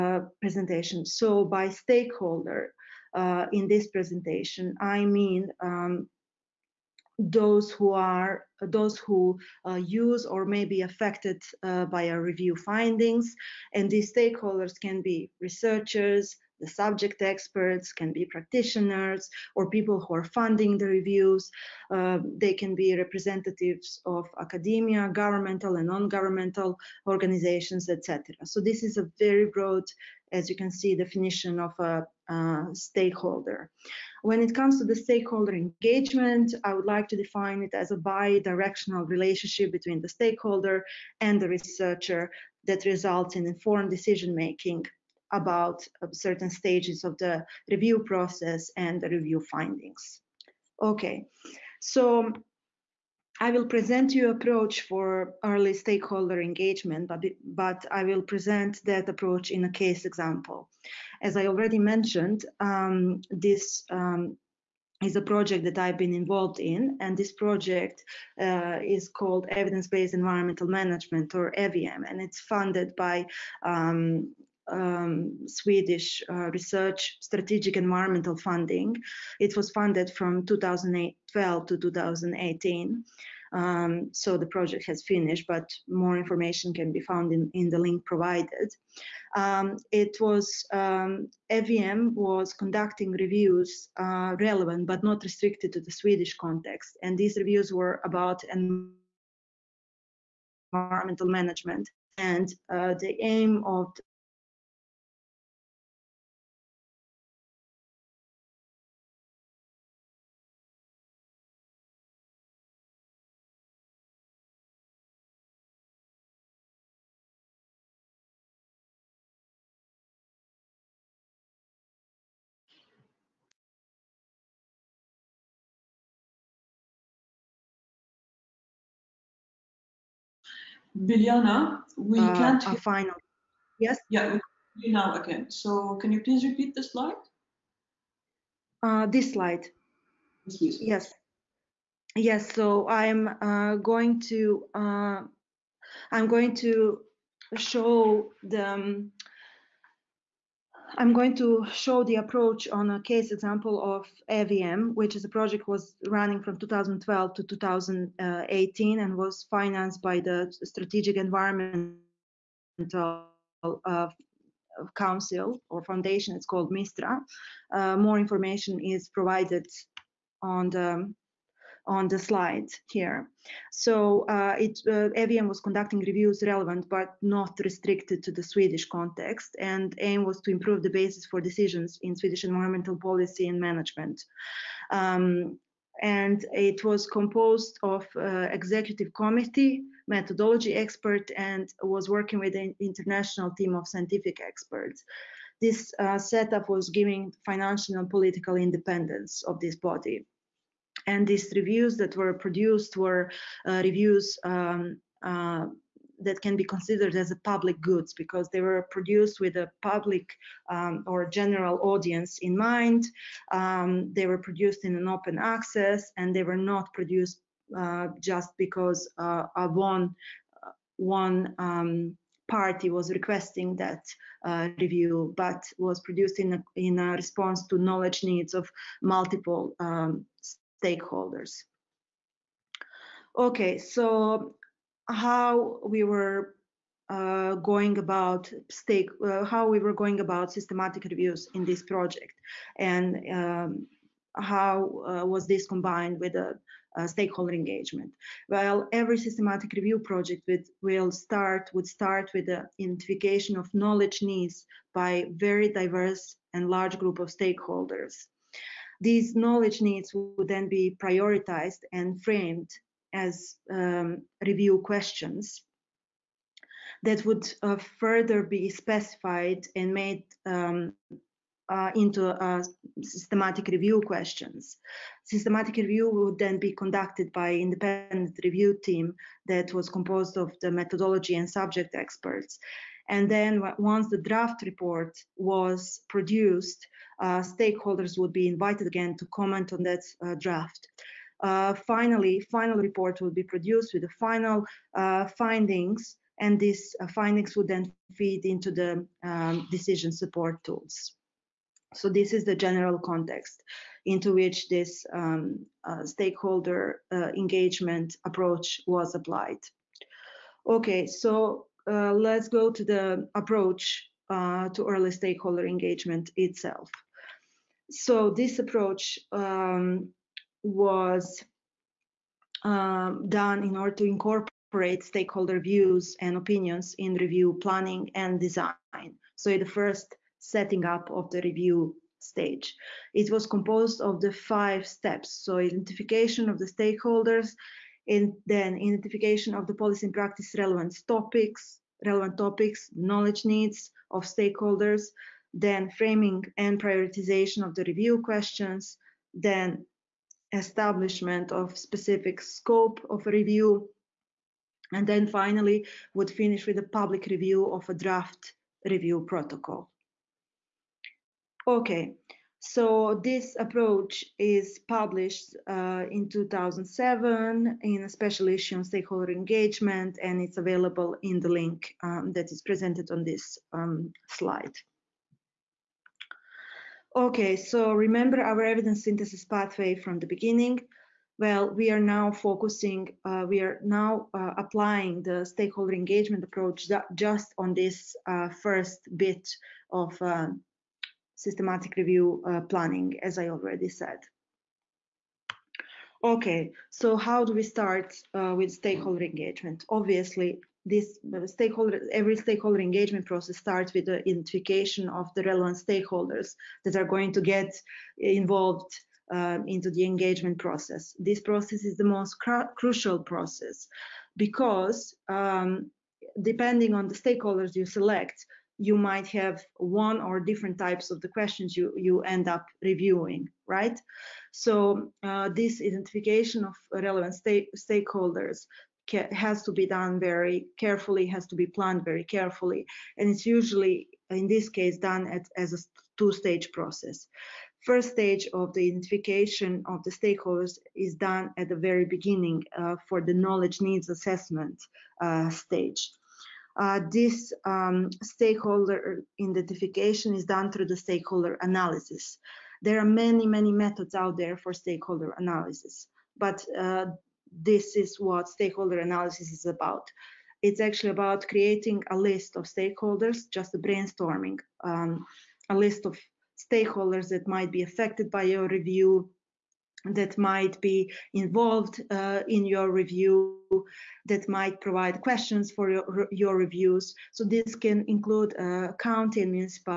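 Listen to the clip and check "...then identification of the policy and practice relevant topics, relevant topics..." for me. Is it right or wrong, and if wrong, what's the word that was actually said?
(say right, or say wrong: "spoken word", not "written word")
right.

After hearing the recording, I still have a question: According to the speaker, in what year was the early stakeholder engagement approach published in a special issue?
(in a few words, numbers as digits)
2007.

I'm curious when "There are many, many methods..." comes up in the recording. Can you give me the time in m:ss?
7:32.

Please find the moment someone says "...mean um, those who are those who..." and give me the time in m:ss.
0:05.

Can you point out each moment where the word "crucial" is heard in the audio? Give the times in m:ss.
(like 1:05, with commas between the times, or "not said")
6:52.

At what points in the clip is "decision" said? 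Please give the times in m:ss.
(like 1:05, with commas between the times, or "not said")
0:43, 3:01, 4:59.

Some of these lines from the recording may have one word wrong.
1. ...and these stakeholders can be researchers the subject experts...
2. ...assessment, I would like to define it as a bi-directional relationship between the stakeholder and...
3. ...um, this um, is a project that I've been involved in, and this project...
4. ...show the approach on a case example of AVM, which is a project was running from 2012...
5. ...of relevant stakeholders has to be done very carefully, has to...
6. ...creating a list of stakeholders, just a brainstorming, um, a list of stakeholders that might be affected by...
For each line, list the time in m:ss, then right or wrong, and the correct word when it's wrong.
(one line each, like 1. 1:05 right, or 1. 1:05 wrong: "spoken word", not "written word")
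1. 0:13 right
2. 0:35 wrong: "engagement", not "assessment"
3. 1:02 right
4. 2:31 right
5. 7:06 right
6. 7:41 right.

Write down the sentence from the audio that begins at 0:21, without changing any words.
Uh, they can be representatives of academia, governmental and non-governmental organizations, etc.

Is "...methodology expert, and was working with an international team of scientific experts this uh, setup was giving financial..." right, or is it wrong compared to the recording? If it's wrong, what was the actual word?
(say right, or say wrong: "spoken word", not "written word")
right.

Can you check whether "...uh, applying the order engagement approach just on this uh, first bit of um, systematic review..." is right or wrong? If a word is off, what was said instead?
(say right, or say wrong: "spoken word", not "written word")
wrong: "stakeholder", not "order".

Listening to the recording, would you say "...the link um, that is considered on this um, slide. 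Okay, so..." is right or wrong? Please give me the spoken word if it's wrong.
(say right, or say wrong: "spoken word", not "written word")
wrong: "presented", not "considered".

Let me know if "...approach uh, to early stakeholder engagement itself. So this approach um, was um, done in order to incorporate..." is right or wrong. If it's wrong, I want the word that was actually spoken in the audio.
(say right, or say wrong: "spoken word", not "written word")
right.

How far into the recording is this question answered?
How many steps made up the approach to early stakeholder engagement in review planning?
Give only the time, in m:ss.
5:34.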